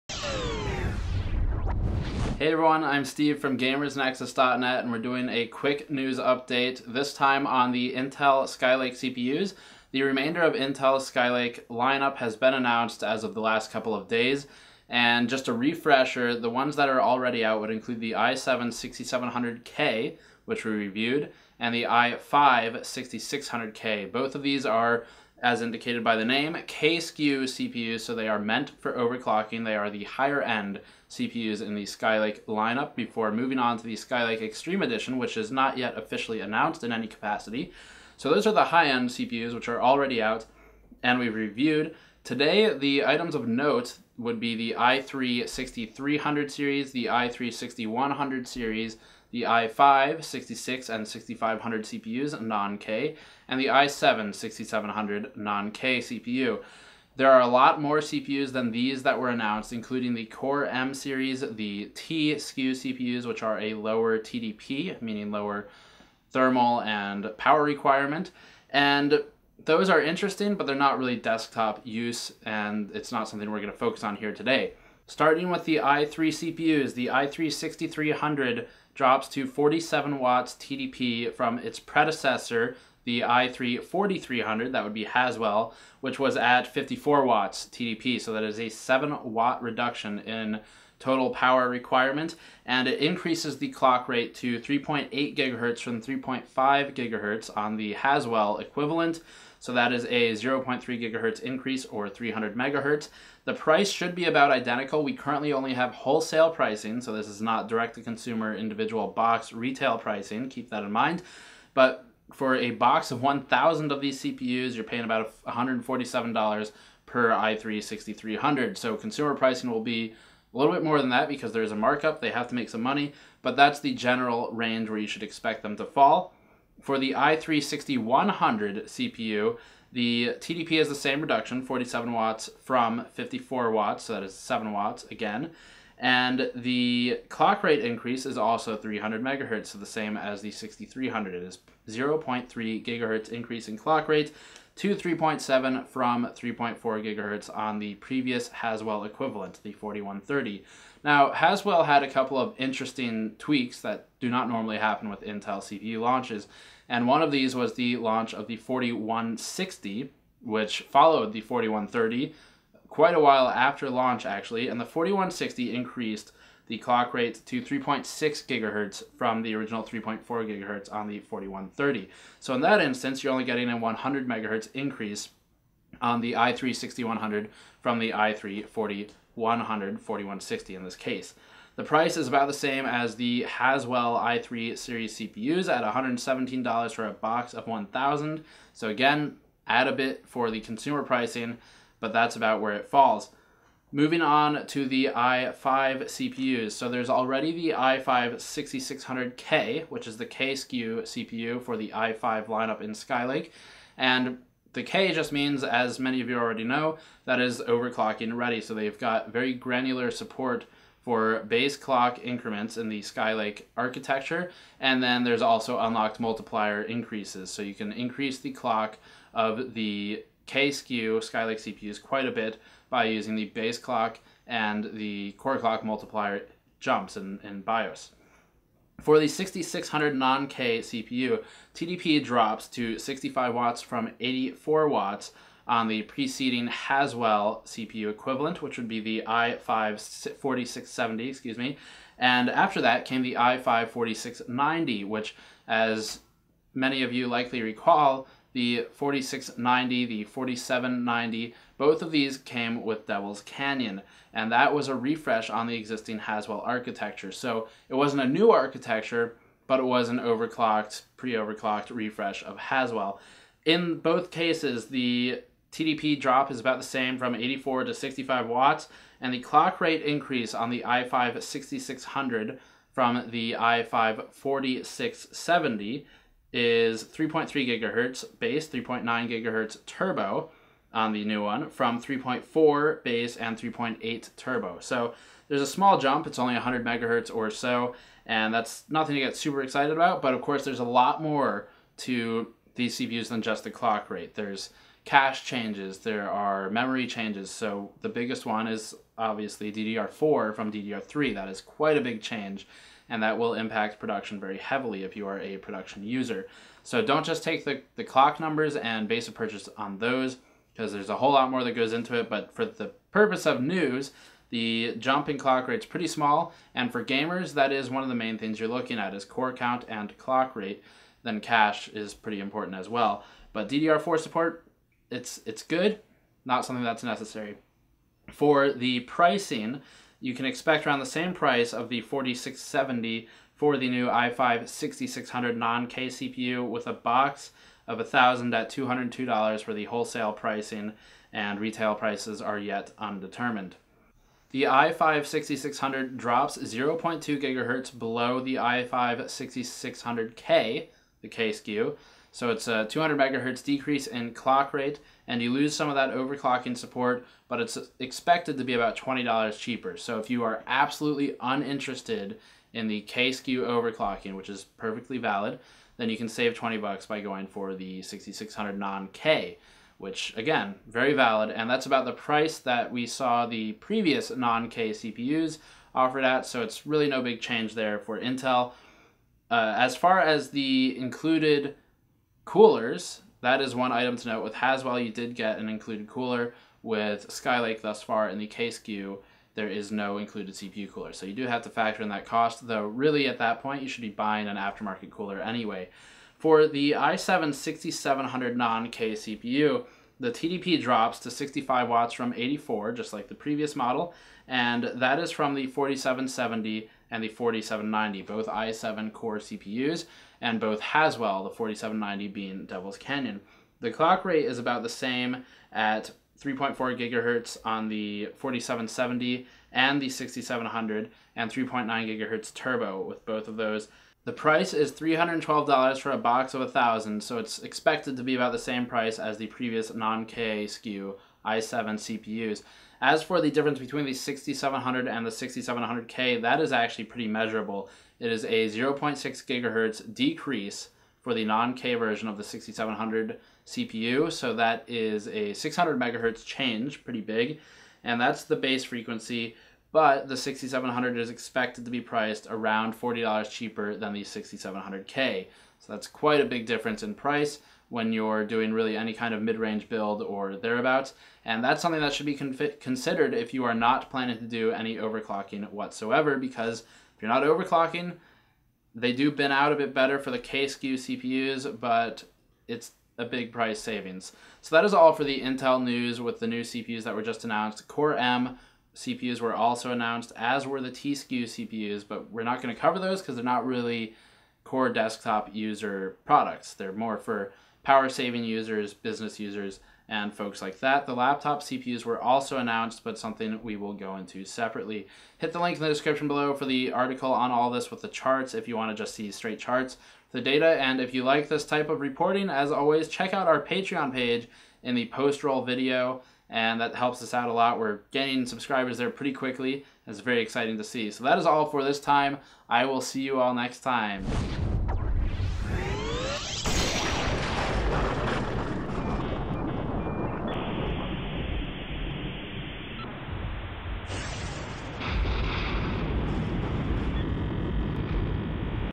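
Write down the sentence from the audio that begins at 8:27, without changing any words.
We're gaining subscribers there pretty quickly.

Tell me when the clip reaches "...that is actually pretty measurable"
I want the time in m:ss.
7:16.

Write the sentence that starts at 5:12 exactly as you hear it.
But for the purpose of news, the jumping clock rate's pretty small.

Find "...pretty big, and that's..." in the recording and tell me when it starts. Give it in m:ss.
7:27.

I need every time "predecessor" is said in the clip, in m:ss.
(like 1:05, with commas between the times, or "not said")
1:21.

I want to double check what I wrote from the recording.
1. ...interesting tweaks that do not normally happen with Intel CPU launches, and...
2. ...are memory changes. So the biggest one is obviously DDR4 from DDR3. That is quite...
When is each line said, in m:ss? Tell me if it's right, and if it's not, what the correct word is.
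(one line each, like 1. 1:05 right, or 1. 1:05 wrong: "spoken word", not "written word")
1. 2:32 right
2. 4:56 right.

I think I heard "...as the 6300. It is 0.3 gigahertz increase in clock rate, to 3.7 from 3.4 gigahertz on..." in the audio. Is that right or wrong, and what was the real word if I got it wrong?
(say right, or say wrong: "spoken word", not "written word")
right.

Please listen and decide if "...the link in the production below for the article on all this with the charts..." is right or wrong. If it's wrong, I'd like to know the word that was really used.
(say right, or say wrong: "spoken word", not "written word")
wrong: "description", not "production".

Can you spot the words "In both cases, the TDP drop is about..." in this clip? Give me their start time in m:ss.
4:23.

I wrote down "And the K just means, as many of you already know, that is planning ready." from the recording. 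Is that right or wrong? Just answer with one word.
wrong.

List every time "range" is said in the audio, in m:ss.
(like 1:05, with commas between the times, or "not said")
2:04, 7:39.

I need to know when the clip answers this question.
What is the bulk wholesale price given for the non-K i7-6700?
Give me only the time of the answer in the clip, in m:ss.
7:04.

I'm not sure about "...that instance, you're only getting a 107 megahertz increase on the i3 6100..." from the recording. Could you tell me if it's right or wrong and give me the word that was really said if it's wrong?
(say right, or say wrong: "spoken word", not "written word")
wrong: "100", not "107".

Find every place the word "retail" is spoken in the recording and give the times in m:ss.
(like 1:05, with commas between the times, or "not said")
1:49, 5:41.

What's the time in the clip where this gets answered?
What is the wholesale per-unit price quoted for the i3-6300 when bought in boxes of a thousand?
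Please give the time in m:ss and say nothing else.
1:55.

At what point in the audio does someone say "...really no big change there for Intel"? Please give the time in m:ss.
6:16.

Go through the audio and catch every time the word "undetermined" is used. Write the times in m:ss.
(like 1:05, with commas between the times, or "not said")
5:42.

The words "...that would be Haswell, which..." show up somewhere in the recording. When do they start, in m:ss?
1:24.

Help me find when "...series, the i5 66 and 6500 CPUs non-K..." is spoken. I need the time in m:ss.
0:48.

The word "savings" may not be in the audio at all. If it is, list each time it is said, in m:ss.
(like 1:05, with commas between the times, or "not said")
7:53, 8:08.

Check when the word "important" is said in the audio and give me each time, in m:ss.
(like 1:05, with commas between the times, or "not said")
5:22.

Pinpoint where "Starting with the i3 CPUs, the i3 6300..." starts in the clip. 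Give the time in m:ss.
1:15.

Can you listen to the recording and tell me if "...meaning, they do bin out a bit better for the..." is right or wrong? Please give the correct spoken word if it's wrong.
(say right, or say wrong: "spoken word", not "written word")
wrong: "overclocking", not "meaning".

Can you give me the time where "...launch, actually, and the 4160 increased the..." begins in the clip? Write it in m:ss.
2:43.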